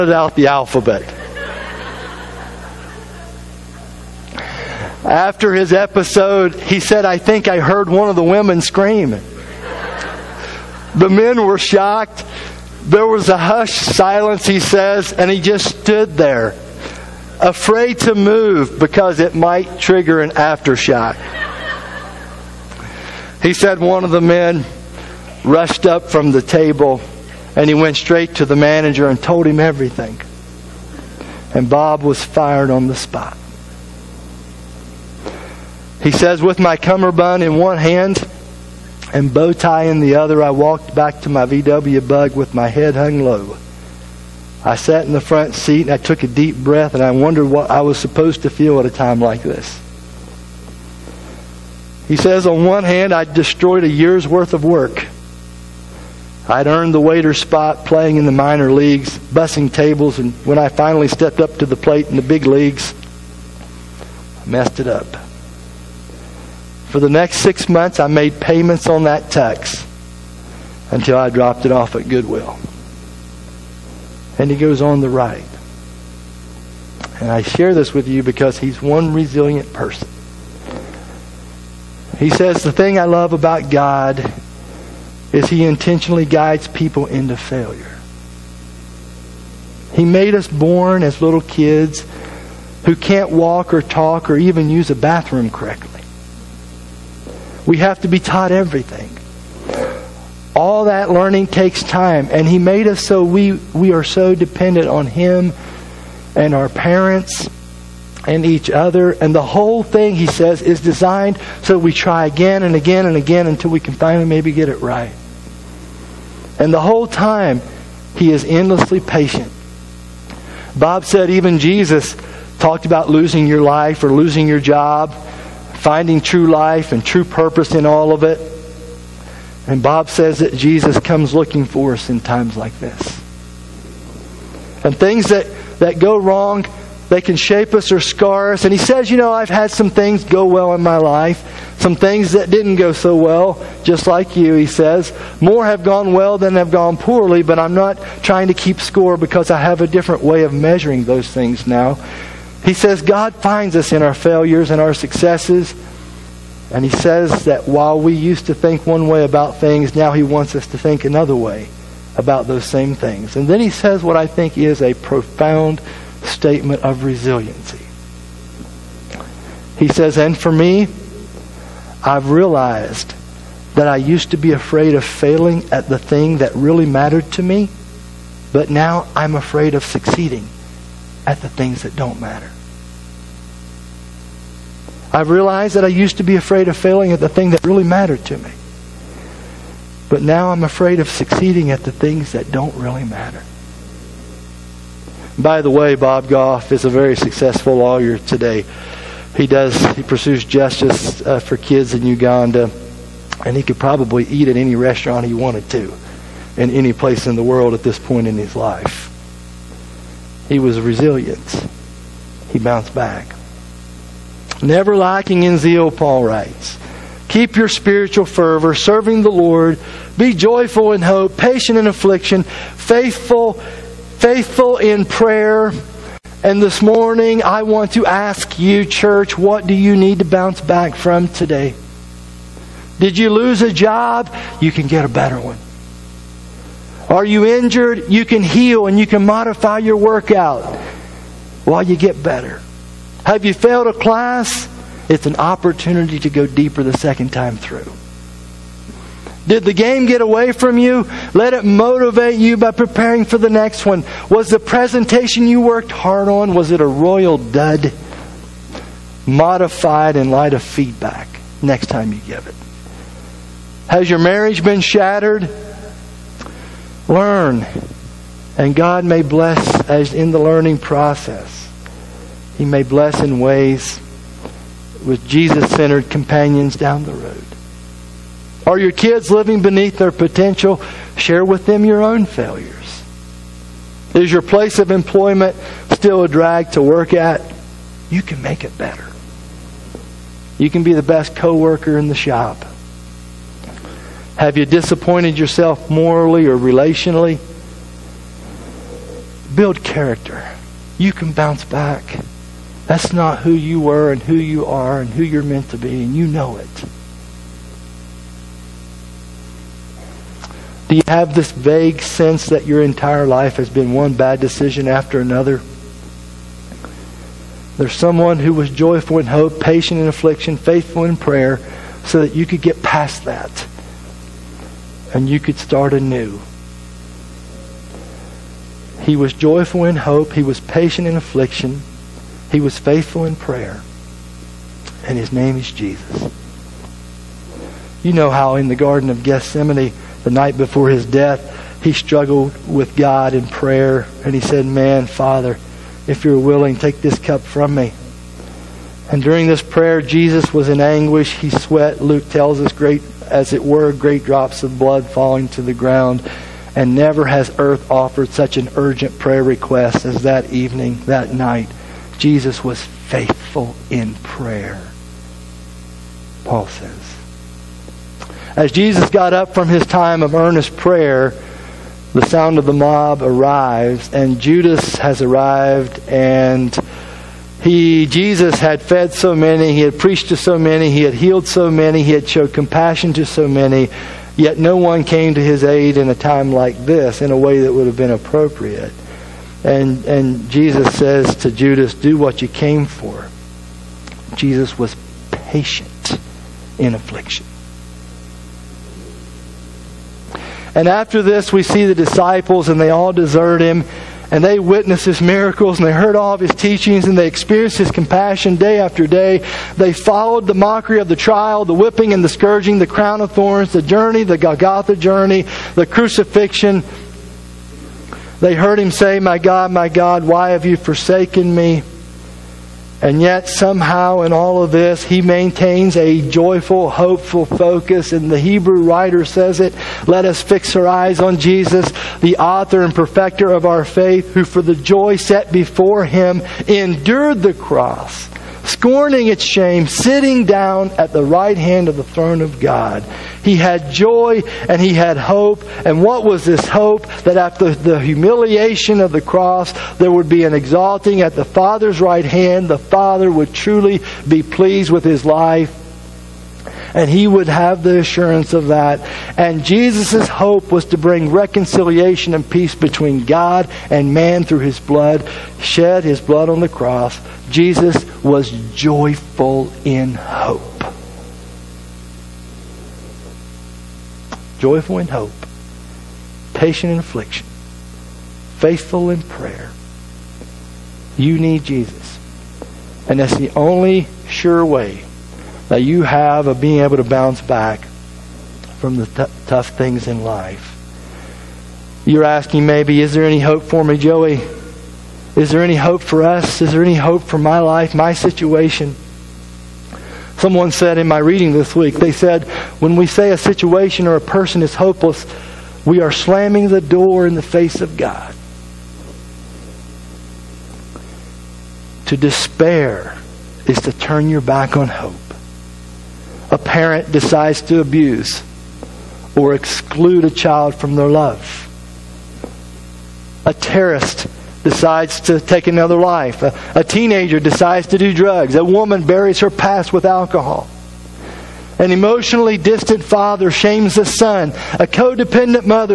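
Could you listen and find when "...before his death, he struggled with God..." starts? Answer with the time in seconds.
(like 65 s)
340 s.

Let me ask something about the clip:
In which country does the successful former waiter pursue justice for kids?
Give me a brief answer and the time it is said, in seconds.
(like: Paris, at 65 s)
Uganda, at 202 s.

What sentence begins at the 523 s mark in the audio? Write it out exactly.
A terrorist decides to take another life.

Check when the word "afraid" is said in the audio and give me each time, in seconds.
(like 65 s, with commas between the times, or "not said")
17 s, 174 s, 179 s, 186 s, 190 s.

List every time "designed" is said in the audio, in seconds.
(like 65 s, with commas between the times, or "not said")
110 s.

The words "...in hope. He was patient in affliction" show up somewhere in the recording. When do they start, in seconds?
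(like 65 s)
329 s.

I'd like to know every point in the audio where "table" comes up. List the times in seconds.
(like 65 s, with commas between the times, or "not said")
26 s, 59 s.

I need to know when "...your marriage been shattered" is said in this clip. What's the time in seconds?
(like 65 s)
264 s.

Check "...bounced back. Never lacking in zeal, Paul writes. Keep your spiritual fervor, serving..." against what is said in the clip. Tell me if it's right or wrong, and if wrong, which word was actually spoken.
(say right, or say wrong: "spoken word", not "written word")
right.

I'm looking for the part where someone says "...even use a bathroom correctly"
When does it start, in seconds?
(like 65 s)
94 s.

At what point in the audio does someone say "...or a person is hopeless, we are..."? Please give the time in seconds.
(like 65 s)
504 s.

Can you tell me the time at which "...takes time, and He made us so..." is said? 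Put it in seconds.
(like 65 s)
101 s.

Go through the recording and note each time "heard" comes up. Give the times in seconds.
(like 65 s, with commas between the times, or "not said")
7 s, 405 s, 418 s.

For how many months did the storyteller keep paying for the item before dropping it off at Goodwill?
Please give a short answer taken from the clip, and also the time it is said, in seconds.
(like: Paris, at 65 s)
6, at 67 s.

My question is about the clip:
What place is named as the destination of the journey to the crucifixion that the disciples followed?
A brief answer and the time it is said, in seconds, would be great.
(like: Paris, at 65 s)
Golgotha, at 414 s.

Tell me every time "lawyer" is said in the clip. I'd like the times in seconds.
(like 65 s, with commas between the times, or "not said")
197 s.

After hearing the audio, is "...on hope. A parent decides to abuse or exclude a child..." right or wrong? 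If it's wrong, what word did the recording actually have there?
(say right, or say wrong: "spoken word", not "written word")
right.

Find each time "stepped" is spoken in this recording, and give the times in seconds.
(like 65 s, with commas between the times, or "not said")
61 s.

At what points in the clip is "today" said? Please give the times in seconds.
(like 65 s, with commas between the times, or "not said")
198 s, 231 s.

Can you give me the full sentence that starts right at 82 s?
He says, The thing I love about God is he intentionally guides people into failure.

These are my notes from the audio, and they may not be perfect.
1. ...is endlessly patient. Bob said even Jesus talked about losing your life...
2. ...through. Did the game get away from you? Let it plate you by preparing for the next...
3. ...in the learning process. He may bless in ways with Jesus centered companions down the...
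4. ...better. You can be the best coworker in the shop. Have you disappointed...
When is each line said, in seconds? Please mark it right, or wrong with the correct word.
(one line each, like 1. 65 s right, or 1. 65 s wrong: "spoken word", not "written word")
1. 118 s right
2. 247 s wrong: "motivate", not "plate"
3. 270 s right
4. 288 s right.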